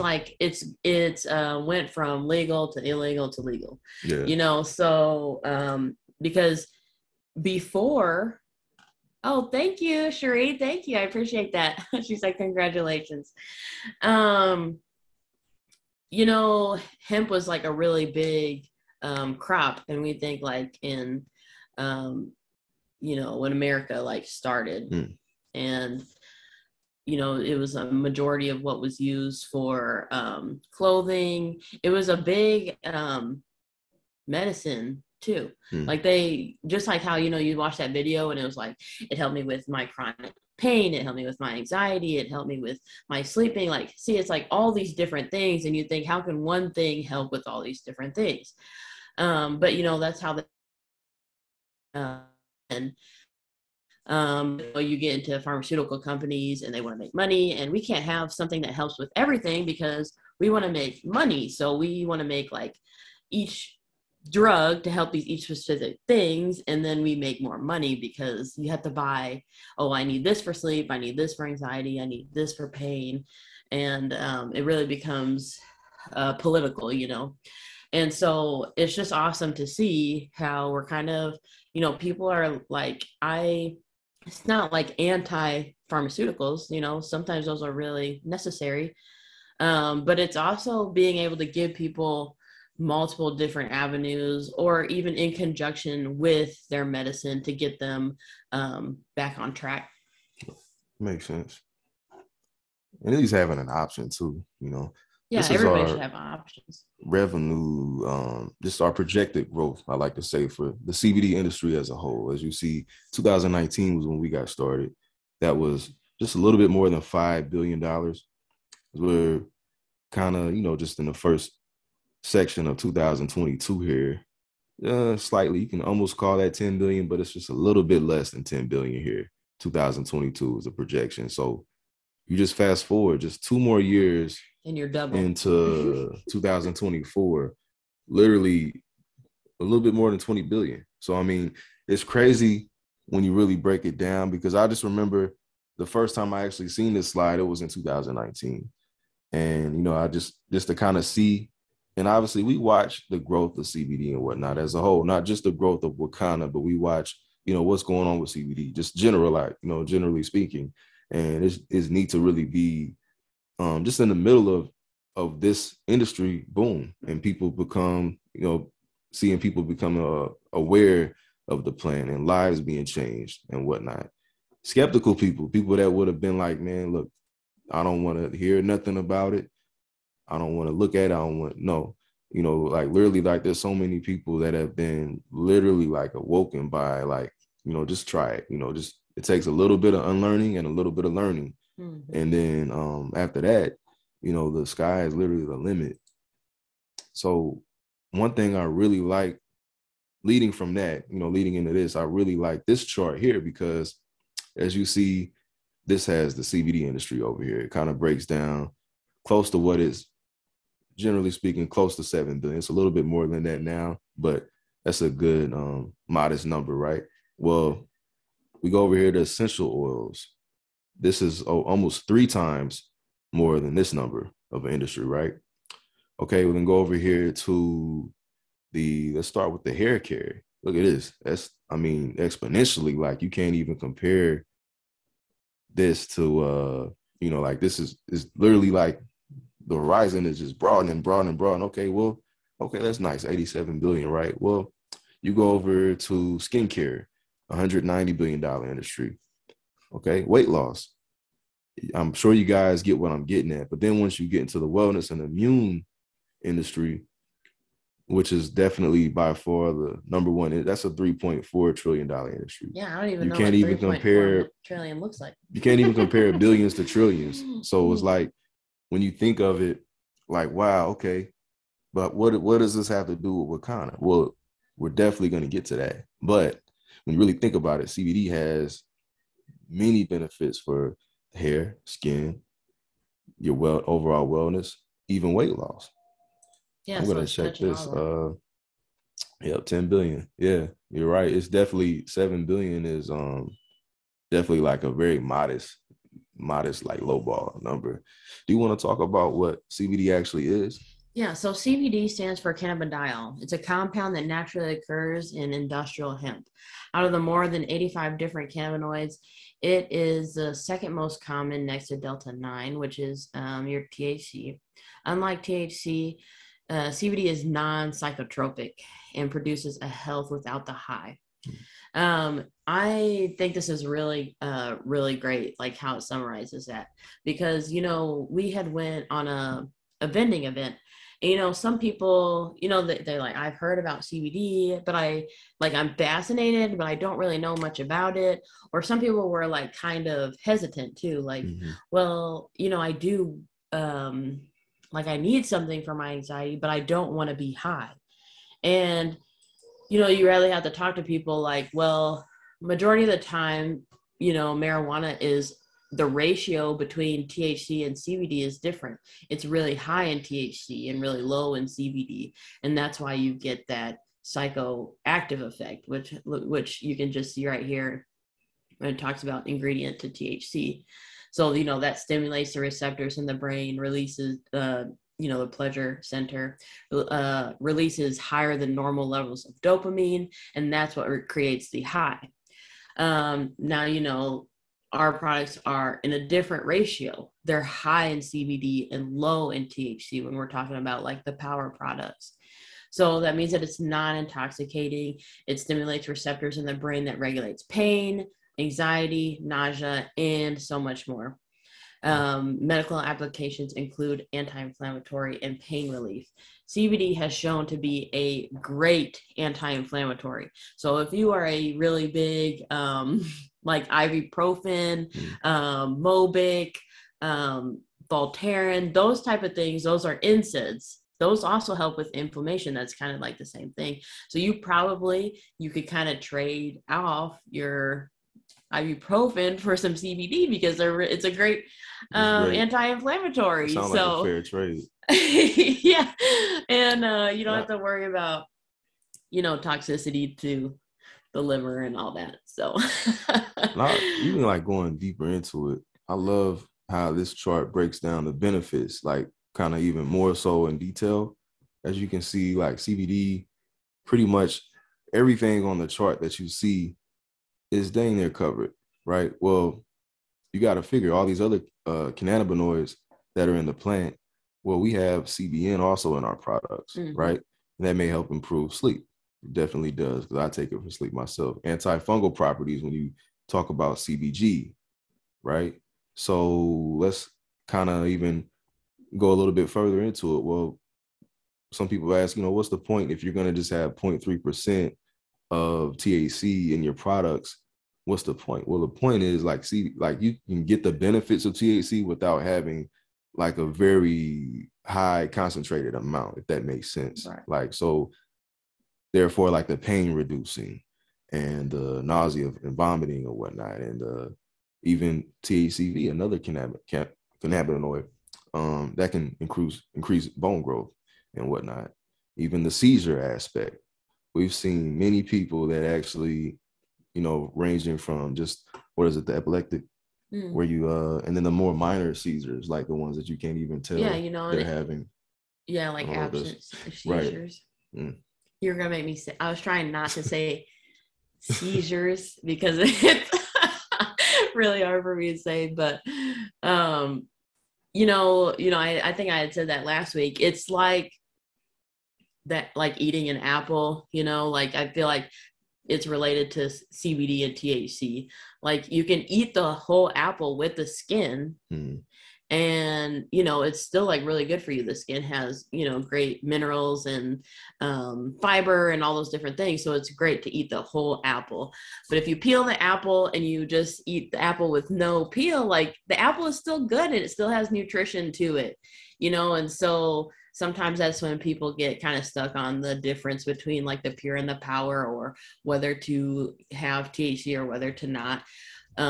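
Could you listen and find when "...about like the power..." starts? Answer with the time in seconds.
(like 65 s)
390 s.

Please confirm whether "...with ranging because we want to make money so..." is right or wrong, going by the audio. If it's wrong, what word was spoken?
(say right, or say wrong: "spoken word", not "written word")
wrong: "everything", not "ranging".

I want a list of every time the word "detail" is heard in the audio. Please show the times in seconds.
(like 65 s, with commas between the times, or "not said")
450 s.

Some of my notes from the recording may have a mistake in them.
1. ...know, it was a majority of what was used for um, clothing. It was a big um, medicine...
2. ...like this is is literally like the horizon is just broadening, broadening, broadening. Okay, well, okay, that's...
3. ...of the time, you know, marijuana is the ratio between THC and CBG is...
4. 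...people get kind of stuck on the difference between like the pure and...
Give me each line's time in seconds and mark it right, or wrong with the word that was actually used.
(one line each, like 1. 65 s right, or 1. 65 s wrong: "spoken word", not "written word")
1. 27 s right
2. 237 s right
3. 353 s wrong: "CBD", not "CBG"
4. 571 s right.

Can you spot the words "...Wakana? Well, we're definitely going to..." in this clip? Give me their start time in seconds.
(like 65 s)
273 s.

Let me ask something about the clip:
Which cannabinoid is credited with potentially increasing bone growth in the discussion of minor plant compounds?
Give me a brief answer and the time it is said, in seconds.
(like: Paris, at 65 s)
THCV, at 505 s.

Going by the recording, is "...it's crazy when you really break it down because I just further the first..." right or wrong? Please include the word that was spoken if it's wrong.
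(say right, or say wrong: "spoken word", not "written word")
wrong: "remember", not "further".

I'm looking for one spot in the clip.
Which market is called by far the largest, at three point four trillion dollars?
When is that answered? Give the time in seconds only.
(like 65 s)
254 s.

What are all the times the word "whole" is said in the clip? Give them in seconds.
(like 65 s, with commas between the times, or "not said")
111 s, 154 s, 549 s, 560 s.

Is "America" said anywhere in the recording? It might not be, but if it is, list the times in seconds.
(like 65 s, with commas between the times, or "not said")
23 s.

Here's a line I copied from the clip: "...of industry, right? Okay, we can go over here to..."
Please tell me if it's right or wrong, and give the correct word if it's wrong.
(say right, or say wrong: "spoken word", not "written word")
right.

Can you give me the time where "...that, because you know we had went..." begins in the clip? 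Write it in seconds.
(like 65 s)
326 s.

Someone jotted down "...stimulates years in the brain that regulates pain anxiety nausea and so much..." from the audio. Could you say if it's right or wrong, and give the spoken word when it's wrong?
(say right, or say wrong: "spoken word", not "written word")
wrong: "receptors", not "years".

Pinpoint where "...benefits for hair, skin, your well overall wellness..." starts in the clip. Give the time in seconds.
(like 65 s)
280 s.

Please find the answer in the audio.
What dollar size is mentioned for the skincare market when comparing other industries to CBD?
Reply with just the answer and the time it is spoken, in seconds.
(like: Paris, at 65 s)
190 billion, at 247 s.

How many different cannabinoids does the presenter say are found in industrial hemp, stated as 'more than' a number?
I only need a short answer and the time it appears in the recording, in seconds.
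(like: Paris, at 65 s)
85, at 307 s.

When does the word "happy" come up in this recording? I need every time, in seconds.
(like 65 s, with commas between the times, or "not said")
not said.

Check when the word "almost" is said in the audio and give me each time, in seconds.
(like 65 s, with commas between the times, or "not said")
125 s, 221 s.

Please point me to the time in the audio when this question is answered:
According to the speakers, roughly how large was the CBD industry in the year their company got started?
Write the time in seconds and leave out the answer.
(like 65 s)
116 s.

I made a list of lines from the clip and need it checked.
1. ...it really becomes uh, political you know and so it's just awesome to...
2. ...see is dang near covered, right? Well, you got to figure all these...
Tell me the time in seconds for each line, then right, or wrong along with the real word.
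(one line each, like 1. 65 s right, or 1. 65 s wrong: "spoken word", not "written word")
1. 74 s right
2. 456 s right.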